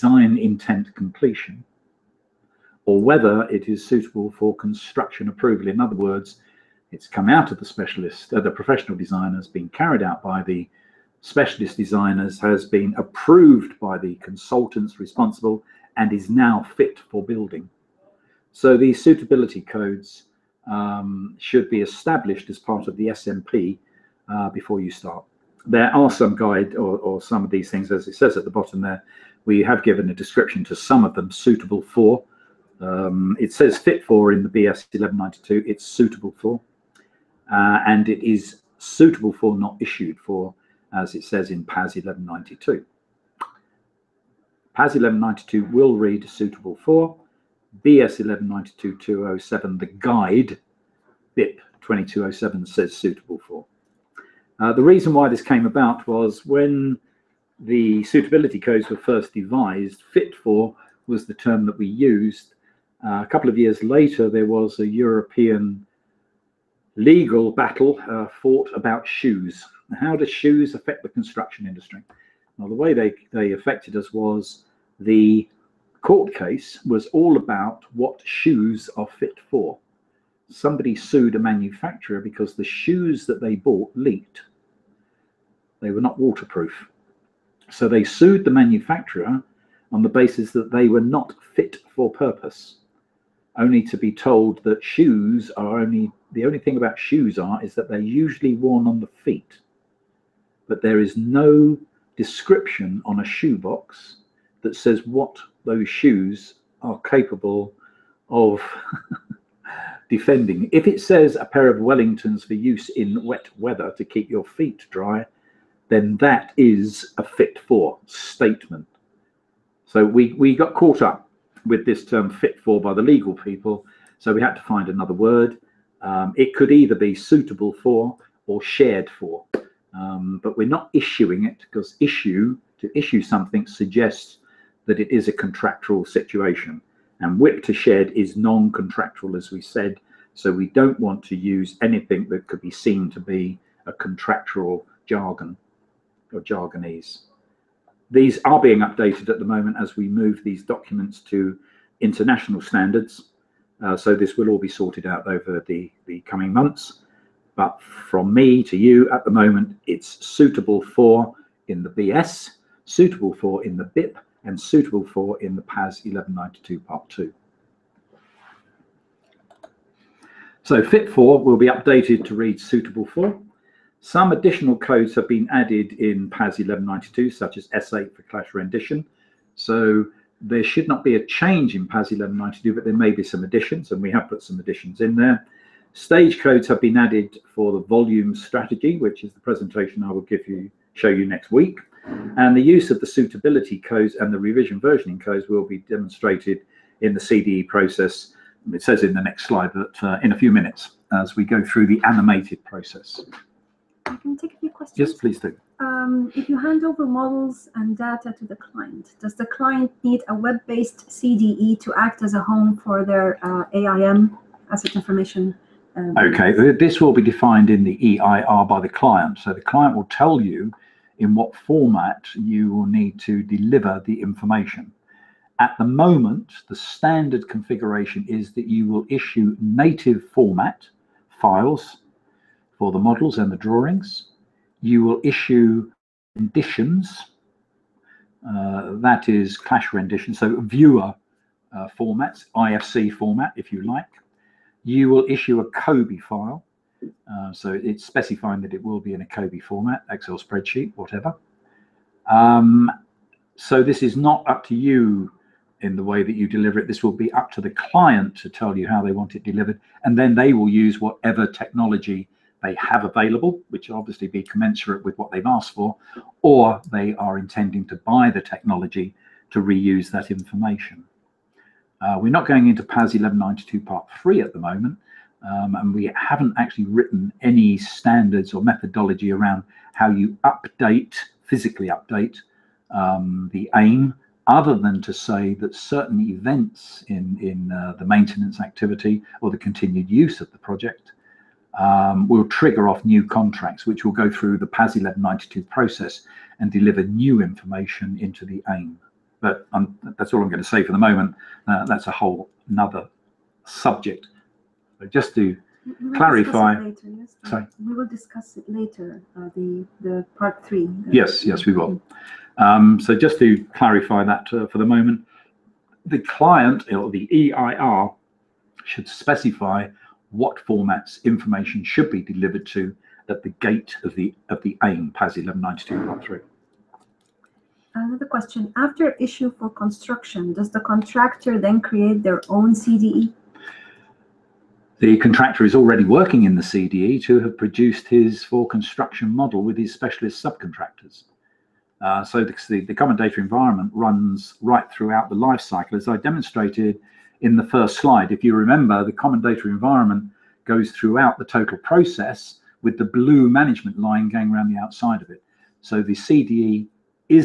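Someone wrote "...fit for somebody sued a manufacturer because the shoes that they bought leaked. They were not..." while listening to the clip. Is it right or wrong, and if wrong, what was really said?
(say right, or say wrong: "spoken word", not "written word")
right.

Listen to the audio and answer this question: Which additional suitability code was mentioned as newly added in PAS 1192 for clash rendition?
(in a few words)
S8.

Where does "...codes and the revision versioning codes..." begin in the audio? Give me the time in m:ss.
3:13.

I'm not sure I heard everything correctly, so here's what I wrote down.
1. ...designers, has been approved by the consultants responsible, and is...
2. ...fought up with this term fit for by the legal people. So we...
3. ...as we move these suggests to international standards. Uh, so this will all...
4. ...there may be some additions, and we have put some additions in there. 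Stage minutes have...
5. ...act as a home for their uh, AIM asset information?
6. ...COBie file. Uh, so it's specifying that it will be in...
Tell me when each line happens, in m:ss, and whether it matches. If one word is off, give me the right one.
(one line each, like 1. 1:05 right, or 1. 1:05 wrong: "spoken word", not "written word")
1. 0:11 right
2. 2:00 wrong: "caught", not "fought"
3. 2:29 wrong: "documents", not "suggests"
4. 3:02 wrong: "codes", not "minutes"
5. 3:31 right
6. 4:05 right.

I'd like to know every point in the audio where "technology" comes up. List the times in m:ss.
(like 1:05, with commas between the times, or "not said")
4:21, 4:28.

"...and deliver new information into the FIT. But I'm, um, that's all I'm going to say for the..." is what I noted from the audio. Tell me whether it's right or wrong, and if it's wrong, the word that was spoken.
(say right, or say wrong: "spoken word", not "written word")
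wrong: "AIM", not "FIT".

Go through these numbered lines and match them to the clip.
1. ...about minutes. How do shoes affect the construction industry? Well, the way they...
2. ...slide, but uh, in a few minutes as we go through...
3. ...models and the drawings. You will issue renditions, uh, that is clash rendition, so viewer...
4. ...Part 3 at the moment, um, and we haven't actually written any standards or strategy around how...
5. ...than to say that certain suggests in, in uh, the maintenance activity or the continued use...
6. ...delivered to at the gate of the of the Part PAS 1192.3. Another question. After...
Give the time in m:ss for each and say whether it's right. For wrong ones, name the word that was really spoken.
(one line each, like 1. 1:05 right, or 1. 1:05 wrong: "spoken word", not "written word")
1. 1:08 wrong: "shoes", not "minutes"
2. 3:19 right
3. 3:52 right
4. 4:33 wrong: "methodology", not "strategy"
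5. 4:44 wrong: "events", not "suggests"
6. 5:22 wrong: "AIM", not "Part".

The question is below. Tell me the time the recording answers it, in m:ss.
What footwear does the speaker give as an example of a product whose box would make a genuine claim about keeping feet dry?
1:51.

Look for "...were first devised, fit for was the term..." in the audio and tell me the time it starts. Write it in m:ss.
0:58.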